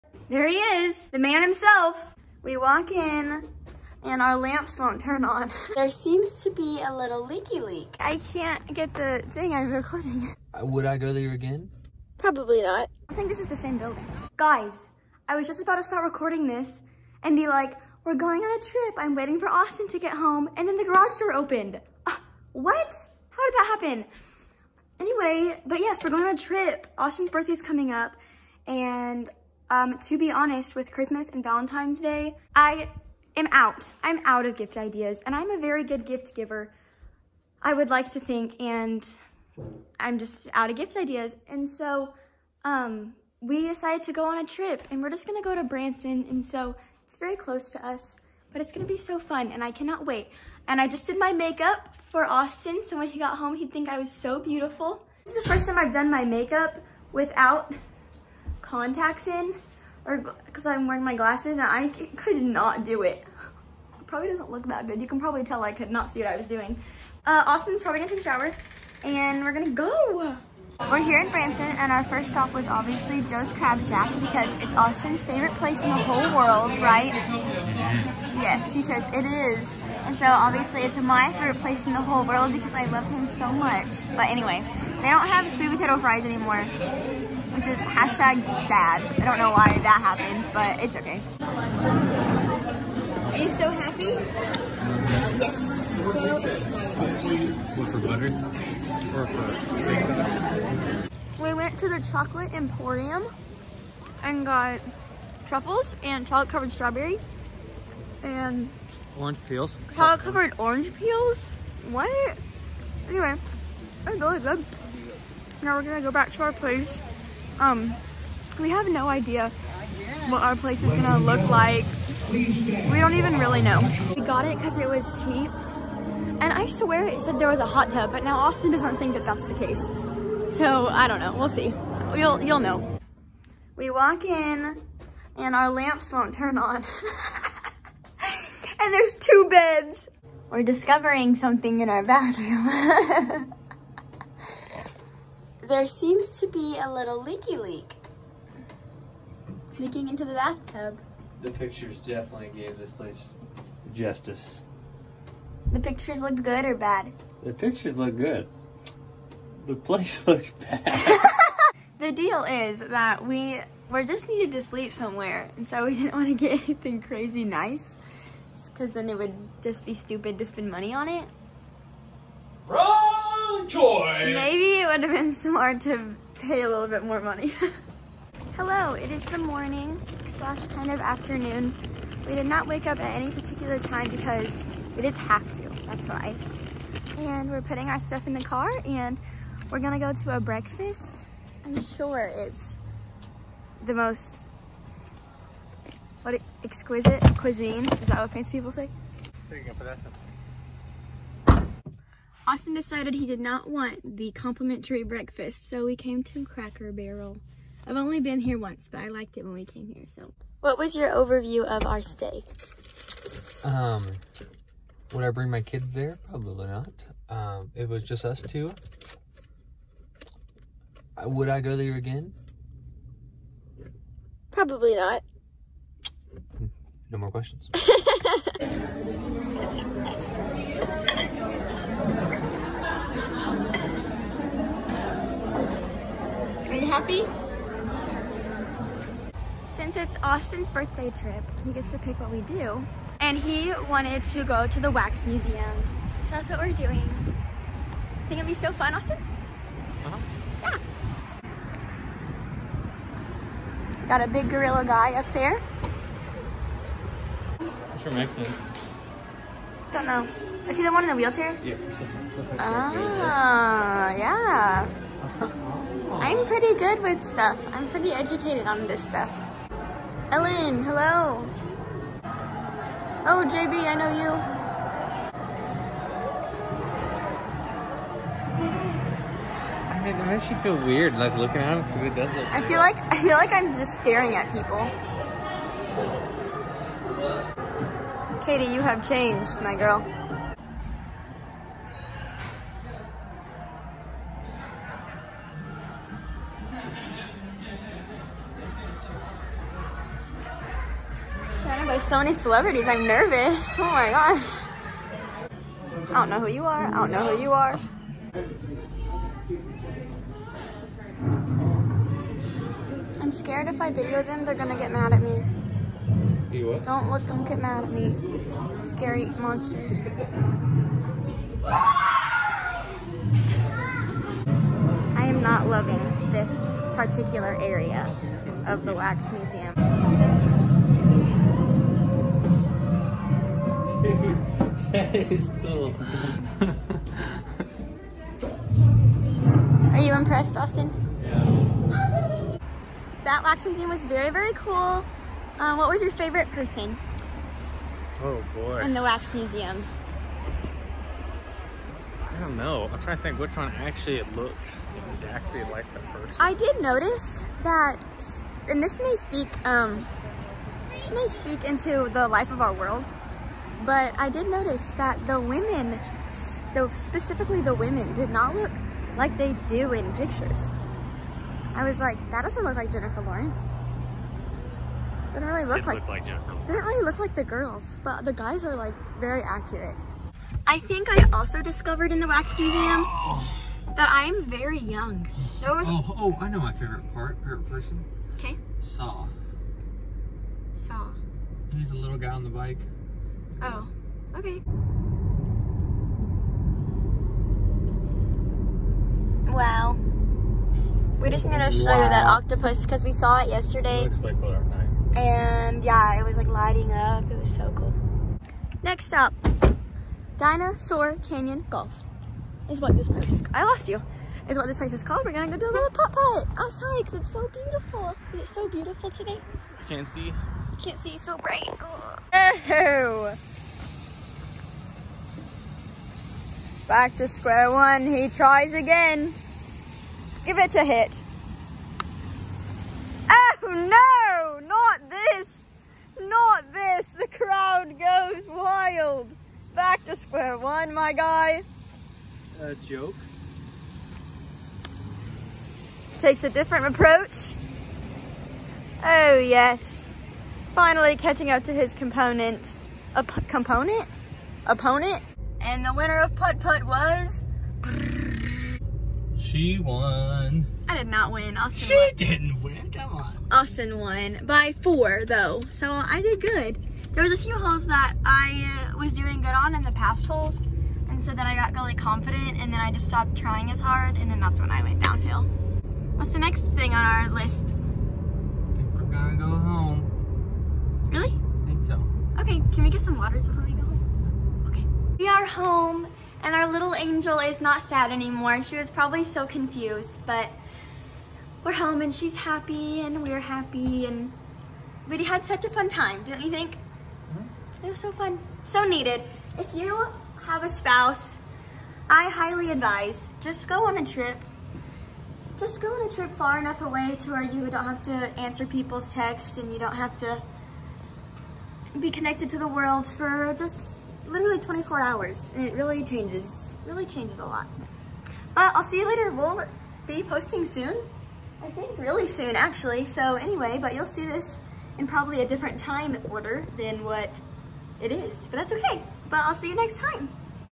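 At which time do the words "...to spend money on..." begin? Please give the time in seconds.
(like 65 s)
170 s.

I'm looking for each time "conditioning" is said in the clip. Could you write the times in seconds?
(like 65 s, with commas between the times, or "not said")
not said.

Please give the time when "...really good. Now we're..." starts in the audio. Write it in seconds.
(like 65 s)
114 s.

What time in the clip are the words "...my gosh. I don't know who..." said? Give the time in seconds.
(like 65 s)
303 s.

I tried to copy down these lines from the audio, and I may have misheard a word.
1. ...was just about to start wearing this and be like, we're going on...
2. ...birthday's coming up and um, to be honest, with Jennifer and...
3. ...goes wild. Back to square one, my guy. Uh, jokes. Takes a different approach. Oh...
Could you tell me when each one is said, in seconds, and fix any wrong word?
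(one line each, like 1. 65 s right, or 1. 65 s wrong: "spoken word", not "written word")
1. 15 s wrong: "recording", not "wearing"
2. 27 s wrong: "Christmas", not "Jennifer"
3. 437 s right.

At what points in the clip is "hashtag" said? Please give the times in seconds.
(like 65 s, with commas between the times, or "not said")
87 s.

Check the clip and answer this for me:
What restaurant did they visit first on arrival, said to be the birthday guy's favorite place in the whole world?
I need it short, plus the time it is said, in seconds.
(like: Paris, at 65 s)
Joe's Crab Shack, at 73 s.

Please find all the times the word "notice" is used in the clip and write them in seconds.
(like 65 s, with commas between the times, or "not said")
356 s, 364 s.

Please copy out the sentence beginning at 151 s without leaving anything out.
The pictures definitely gave this place justice.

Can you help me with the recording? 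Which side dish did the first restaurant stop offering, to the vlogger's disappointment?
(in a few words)
Sweet potato fries.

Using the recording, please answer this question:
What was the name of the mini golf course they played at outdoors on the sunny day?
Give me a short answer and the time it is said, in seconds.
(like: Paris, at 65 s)
Dinosaur Canyon Golf, at 410 s.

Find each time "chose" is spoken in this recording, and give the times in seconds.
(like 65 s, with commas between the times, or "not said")
not said.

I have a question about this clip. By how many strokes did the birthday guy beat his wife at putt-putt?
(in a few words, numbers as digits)
4.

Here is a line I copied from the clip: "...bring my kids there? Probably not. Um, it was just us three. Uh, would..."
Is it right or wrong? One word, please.
wrong.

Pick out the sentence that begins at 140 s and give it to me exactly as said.
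We're discovering something in our bathroom.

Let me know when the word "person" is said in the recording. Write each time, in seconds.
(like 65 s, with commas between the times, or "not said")
346 s, 387 s.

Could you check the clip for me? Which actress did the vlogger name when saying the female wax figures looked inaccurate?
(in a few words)
Jennifer Lawrence.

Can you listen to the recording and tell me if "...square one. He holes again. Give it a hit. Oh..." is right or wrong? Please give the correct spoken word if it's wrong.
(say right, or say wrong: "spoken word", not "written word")
wrong: "tries", not "holes".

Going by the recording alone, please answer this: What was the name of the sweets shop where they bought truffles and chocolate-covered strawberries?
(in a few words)
Chocolate Emporium.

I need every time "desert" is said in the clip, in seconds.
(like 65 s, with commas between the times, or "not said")
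282 s.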